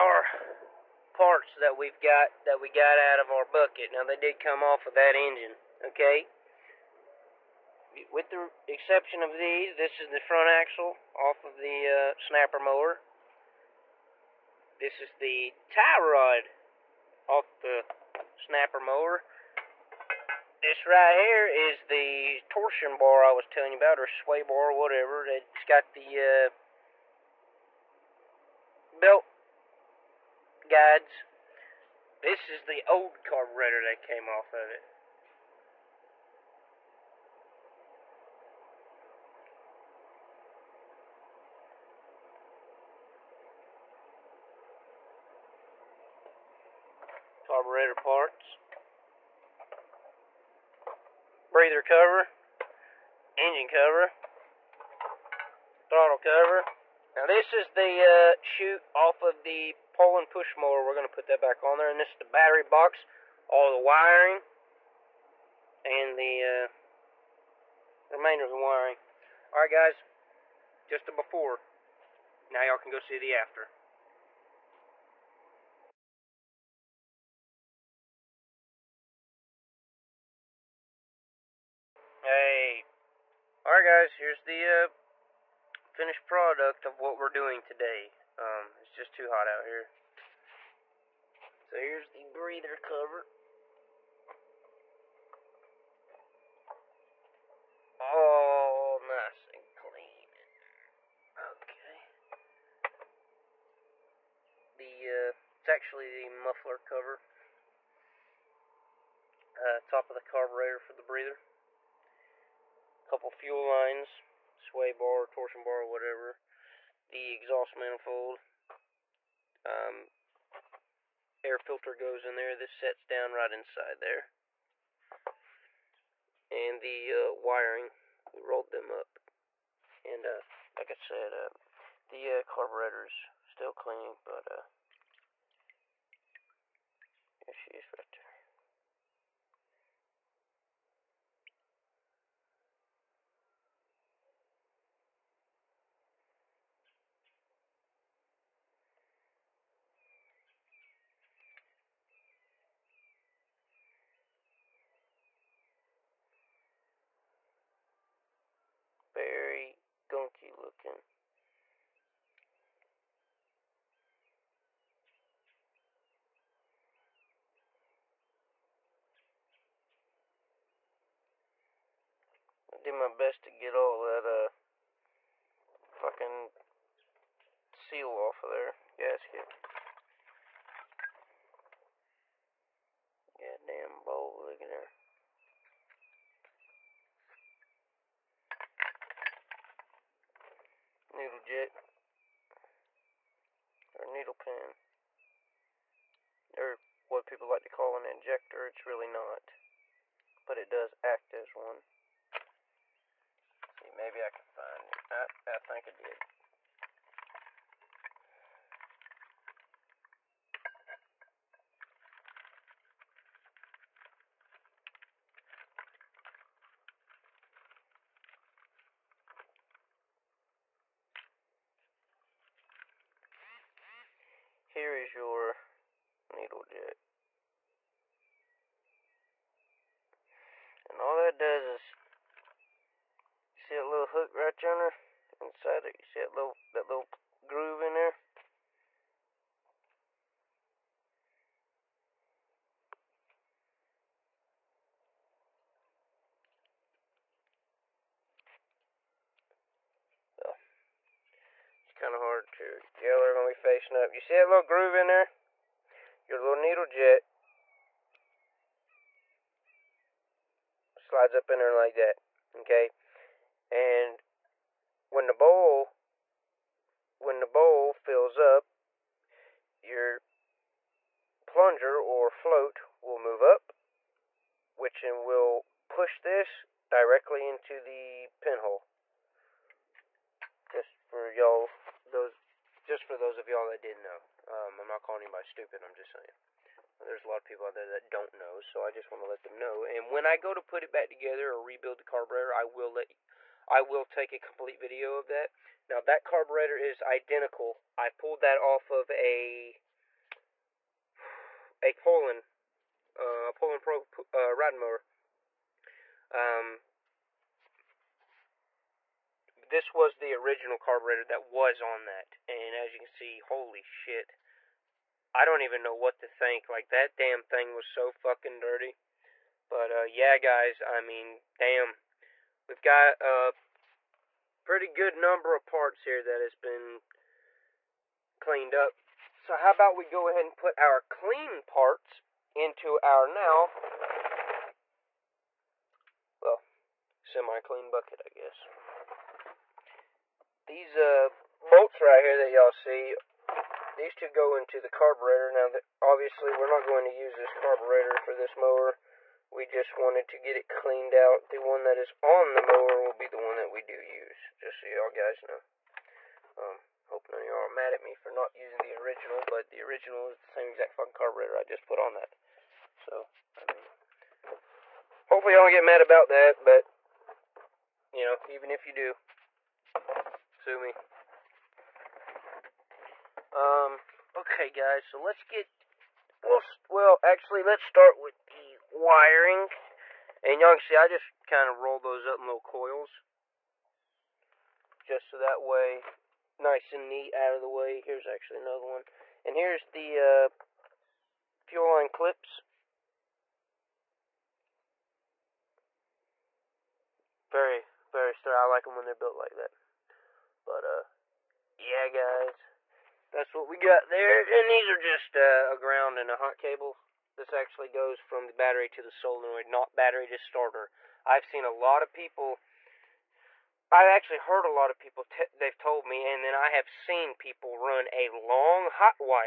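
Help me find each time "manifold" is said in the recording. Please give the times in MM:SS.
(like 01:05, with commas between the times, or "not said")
01:57.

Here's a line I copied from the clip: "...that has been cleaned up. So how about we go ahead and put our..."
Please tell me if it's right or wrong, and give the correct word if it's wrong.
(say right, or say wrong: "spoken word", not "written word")
right.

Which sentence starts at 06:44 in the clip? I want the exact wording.
And these are just uh, a ground and a hot cable.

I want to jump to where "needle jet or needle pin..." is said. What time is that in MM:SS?
03:11.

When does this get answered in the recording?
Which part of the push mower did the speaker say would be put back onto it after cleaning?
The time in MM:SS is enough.
00:58.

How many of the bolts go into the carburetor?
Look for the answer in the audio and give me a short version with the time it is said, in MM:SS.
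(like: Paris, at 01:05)
2, at 05:44.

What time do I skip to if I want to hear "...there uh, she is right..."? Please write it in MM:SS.
02:14.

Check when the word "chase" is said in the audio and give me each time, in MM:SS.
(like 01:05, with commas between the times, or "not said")
not said.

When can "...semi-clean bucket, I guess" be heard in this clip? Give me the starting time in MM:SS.
05:37.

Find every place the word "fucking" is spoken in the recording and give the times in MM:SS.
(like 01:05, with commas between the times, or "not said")
02:55, 05:18, 06:00.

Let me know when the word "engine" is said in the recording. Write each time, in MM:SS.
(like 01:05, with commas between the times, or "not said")
00:05, 00:53.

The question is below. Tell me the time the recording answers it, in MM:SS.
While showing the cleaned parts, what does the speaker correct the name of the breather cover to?
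01:46.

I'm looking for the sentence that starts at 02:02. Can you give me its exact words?
This sets down right inside there.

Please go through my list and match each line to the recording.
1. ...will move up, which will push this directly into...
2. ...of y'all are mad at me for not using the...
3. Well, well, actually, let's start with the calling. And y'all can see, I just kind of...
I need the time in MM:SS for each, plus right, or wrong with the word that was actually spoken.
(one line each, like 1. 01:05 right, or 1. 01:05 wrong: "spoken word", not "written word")
1. 04:33 right
2. 05:57 right
3. 06:16 wrong: "wiring", not "calling".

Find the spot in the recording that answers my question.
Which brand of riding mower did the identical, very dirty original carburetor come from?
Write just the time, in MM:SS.
05:03.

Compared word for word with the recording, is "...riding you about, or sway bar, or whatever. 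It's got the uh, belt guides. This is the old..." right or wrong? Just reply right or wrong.
wrong.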